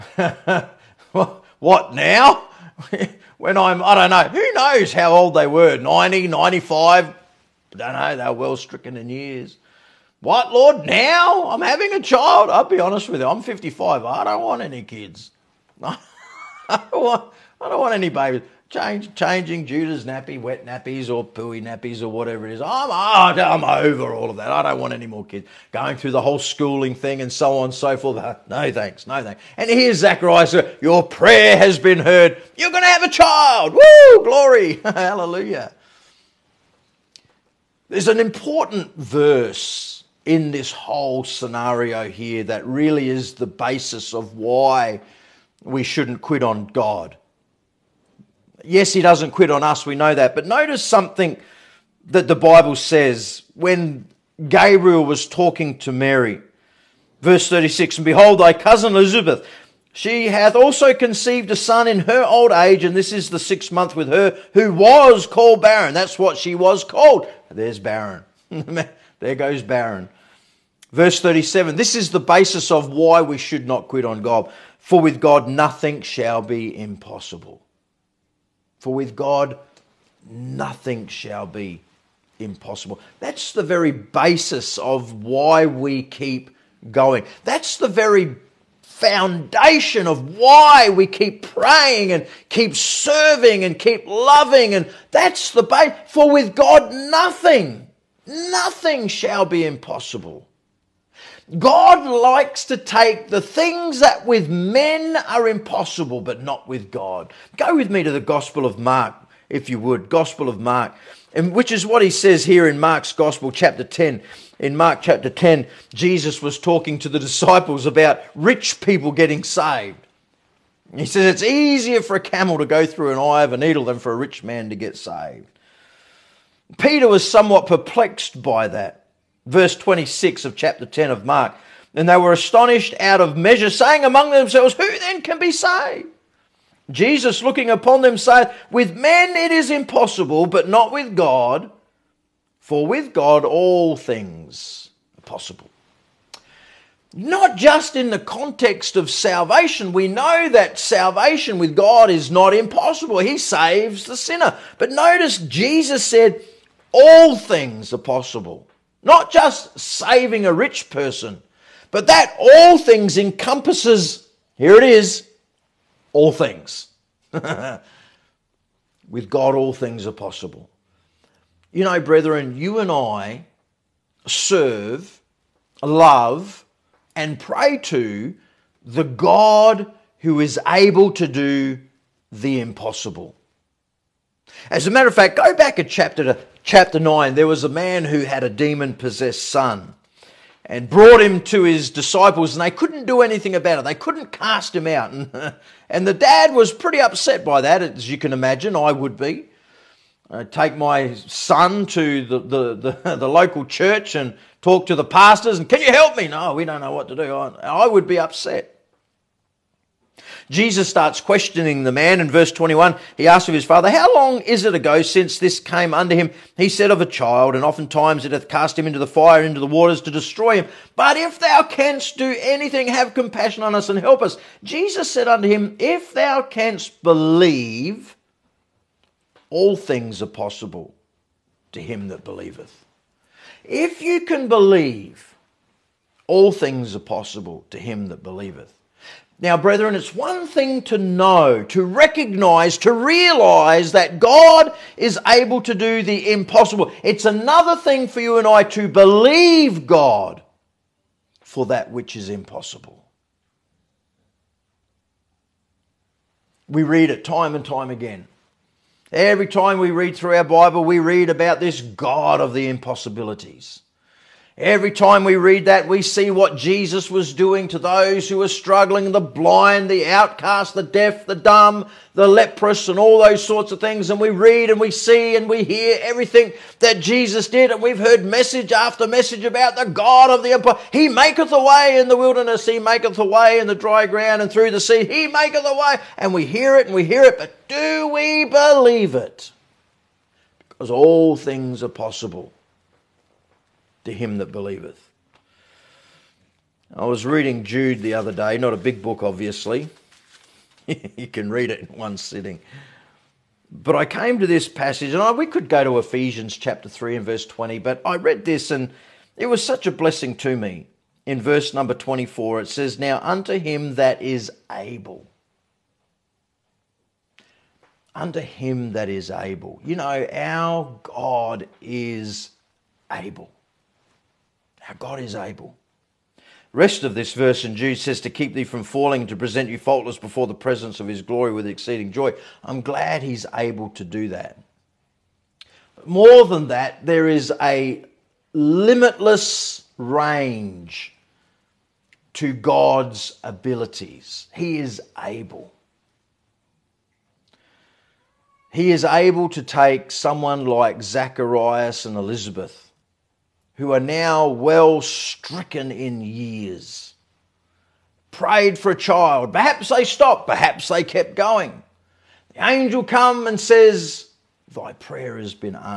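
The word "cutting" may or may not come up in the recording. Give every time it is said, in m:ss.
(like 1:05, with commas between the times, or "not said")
not said.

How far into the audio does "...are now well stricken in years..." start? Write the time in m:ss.
5:53.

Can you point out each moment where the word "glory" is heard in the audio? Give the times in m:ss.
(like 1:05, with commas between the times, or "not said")
0:34, 5:31.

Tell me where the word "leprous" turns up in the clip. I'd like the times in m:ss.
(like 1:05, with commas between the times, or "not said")
4:32.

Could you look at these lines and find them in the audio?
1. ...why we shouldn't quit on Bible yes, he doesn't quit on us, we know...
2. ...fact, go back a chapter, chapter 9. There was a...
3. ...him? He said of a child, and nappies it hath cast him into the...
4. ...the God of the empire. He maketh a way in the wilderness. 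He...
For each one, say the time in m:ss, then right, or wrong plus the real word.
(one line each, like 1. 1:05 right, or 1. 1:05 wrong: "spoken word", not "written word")
1. 0:44 wrong: "God", not "Bible"
2. 3:05 right
3. 3:36 wrong: "oftentimes", not "nappies"
4. 4:39 right.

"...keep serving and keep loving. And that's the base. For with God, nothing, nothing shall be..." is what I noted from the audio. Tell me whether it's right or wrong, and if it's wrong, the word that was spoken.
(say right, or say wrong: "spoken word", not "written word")
right.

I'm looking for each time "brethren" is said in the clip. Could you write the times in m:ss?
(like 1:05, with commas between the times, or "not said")
2:51, 3:59.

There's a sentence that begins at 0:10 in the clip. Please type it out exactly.
What, Lord, now I'm having a child?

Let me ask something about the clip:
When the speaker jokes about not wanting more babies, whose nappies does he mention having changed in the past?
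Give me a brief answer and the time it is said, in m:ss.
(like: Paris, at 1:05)
Judah, at 0:19.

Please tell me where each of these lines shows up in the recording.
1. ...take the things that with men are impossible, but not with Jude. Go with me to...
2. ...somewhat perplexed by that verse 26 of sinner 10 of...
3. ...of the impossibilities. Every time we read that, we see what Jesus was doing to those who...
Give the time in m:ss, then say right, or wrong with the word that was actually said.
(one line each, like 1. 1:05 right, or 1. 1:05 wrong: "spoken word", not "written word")
1. 1:42 wrong: "God", not "Jude"
2. 2:07 wrong: "chapter", not "sinner"
3. 4:22 right.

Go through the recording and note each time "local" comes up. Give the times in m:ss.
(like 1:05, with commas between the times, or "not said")
3:23.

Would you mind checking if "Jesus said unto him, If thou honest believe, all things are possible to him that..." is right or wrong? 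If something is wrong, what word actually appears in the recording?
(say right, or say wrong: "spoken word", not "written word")
wrong: "canst", not "honest".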